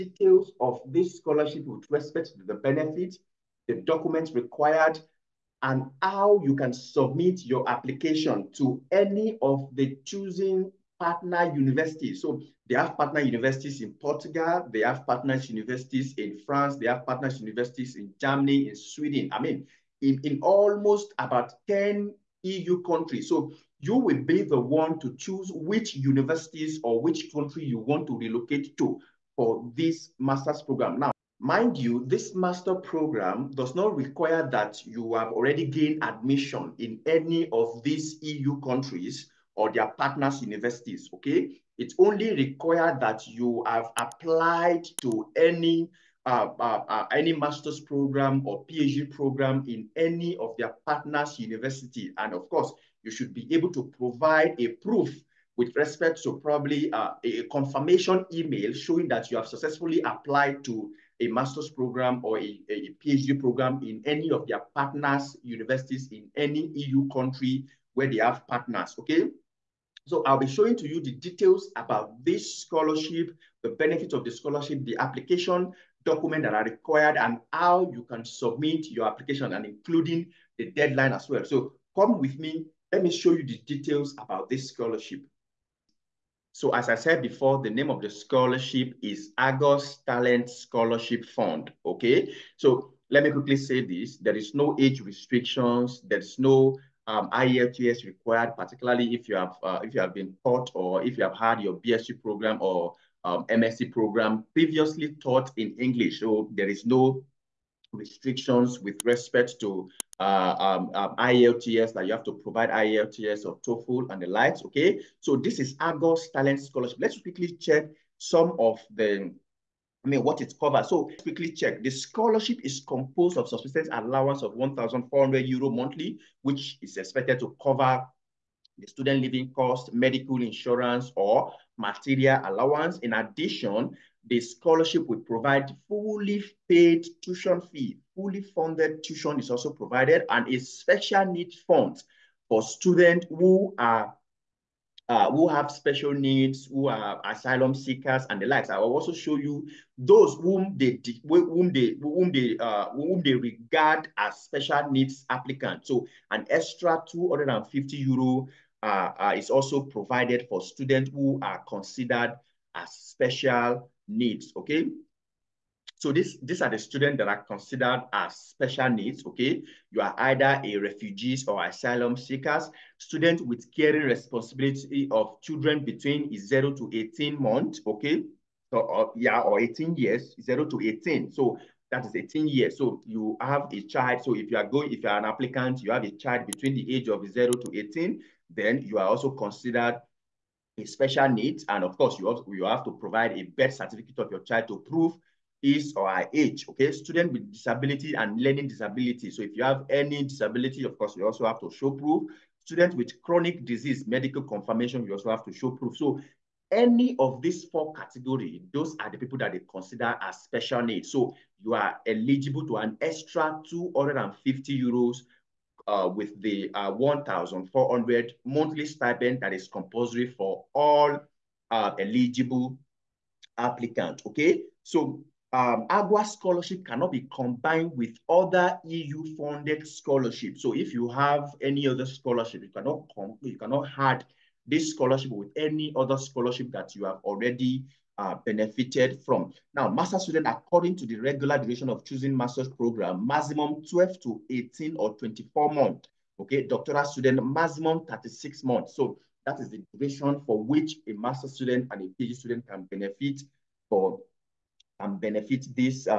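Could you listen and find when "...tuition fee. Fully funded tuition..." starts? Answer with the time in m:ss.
2:17.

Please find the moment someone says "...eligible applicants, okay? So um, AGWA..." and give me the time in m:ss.
3:41.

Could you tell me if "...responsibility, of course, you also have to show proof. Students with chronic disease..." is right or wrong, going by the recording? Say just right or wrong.
wrong.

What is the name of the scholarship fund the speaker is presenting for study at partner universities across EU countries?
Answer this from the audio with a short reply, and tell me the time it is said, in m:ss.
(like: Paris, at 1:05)
Argos Talent Scholarship Fund, at 1:29.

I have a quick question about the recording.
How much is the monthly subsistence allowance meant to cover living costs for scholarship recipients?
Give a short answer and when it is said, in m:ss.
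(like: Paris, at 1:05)
1,400 euro, at 2:04.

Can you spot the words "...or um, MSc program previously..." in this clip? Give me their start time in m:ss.
1:42.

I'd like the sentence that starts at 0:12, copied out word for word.
So they have partner universities in Portugal, they have partner universities in France, they have partner universities in Germany, in Sweden.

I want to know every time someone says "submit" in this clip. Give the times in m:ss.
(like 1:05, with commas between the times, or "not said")
0:06, 1:18.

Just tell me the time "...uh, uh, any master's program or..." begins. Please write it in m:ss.
0:46.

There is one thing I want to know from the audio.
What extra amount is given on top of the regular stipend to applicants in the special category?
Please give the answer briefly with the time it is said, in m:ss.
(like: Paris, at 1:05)
250 euro, at 2:37.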